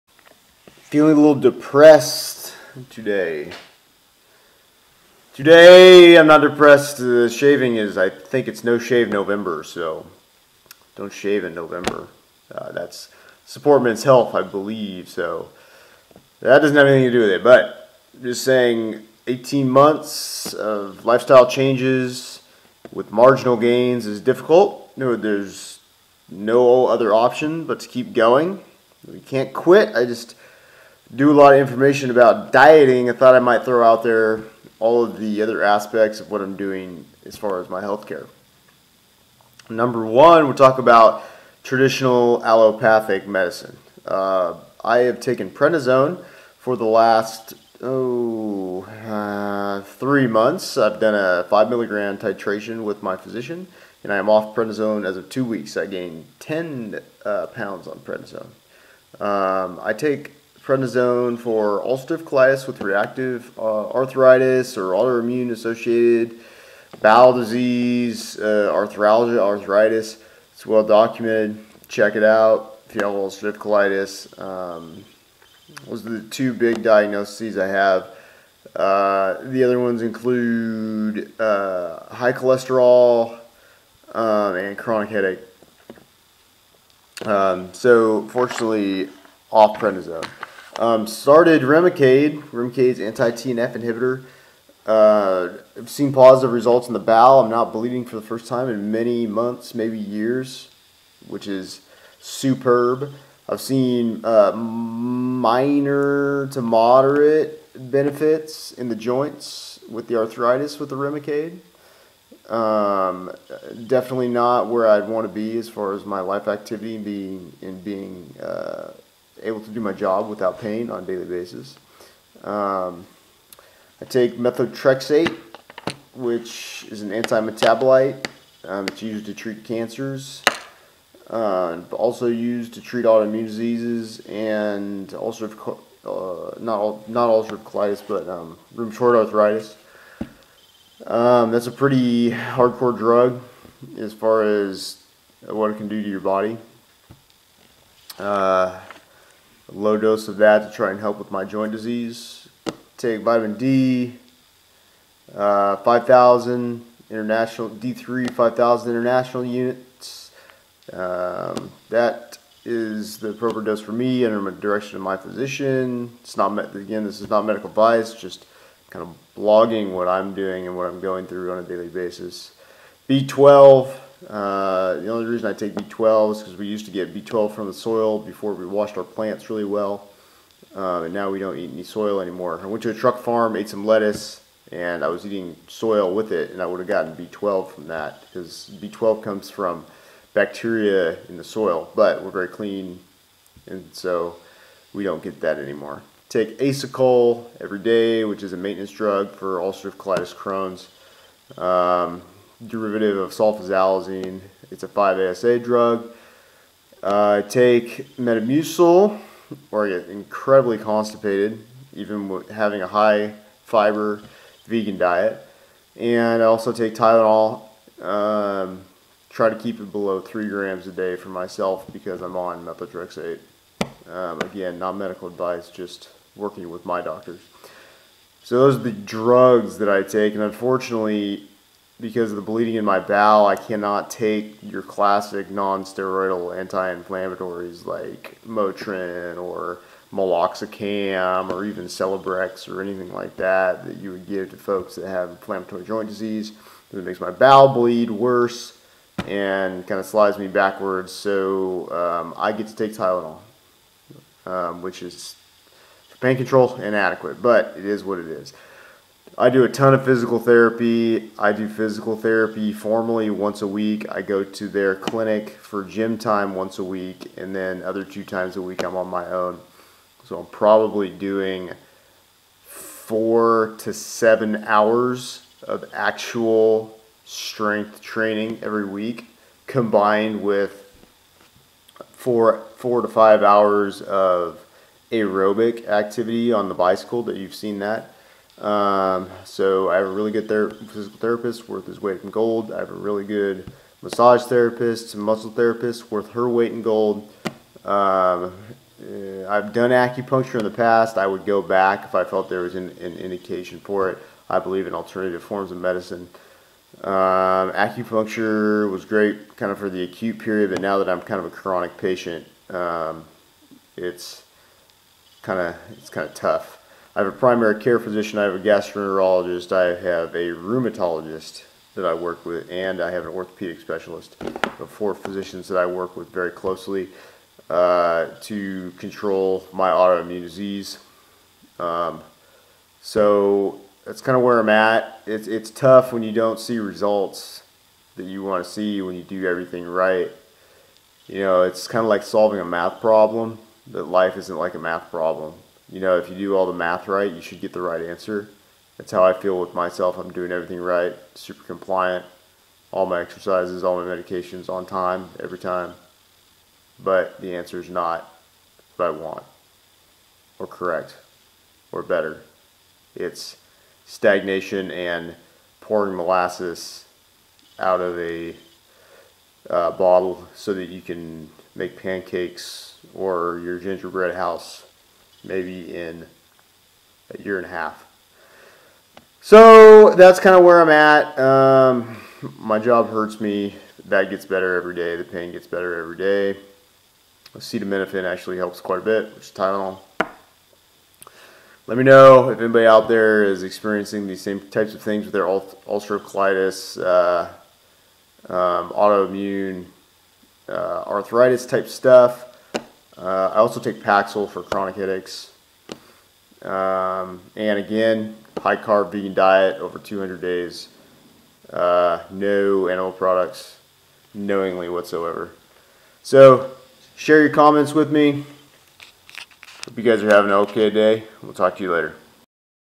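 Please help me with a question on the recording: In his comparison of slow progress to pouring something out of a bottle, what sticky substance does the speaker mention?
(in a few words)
molasses.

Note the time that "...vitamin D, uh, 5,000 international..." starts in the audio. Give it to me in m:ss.
2:33.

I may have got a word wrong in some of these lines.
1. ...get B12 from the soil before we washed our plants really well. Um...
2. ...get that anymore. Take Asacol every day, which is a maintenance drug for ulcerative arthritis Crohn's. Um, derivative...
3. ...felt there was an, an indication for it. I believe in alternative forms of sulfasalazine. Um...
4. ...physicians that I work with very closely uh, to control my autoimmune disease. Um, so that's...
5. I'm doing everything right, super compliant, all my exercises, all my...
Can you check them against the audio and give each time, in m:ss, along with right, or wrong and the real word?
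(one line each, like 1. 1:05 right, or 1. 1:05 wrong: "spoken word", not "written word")
1. 2:56 right
2. 3:15 wrong: "colitis", not "arthritis"
3. 5:02 wrong: "medicine", not "sulfasalazine"
4. 5:25 right
5. 5:50 right.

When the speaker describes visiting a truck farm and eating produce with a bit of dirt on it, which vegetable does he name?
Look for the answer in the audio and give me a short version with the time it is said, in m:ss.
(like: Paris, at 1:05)
lettuce, at 3:03.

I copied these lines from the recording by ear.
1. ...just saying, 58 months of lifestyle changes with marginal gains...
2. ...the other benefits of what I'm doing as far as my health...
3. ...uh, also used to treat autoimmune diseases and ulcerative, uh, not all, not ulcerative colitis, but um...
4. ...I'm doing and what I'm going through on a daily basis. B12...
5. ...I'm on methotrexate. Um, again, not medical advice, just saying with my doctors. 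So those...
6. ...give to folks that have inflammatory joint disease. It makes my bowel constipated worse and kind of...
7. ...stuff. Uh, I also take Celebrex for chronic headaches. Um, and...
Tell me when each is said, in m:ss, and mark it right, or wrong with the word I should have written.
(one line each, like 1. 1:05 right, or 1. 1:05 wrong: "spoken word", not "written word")
1. 0:18 wrong: "18", not "58"
2. 0:35 wrong: "aspects", not "benefits"
3. 2:11 right
4. 2:50 right
5. 3:42 wrong: "working", not "saying"
6. 4:04 wrong: "bleed", not "constipated"
7. 6:41 wrong: "Paxil", not "Celebrex".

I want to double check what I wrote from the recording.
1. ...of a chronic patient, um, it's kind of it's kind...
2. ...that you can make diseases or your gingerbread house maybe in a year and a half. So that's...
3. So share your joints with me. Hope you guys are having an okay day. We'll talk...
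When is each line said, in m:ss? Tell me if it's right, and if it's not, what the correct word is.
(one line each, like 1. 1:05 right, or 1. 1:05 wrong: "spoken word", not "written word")
1. 5:11 right
2. 6:10 wrong: "pancakes", not "diseases"
3. 6:56 wrong: "comments", not "joints".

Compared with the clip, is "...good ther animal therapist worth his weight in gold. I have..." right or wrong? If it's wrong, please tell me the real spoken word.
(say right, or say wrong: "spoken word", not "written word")
wrong: "physical", not "animal".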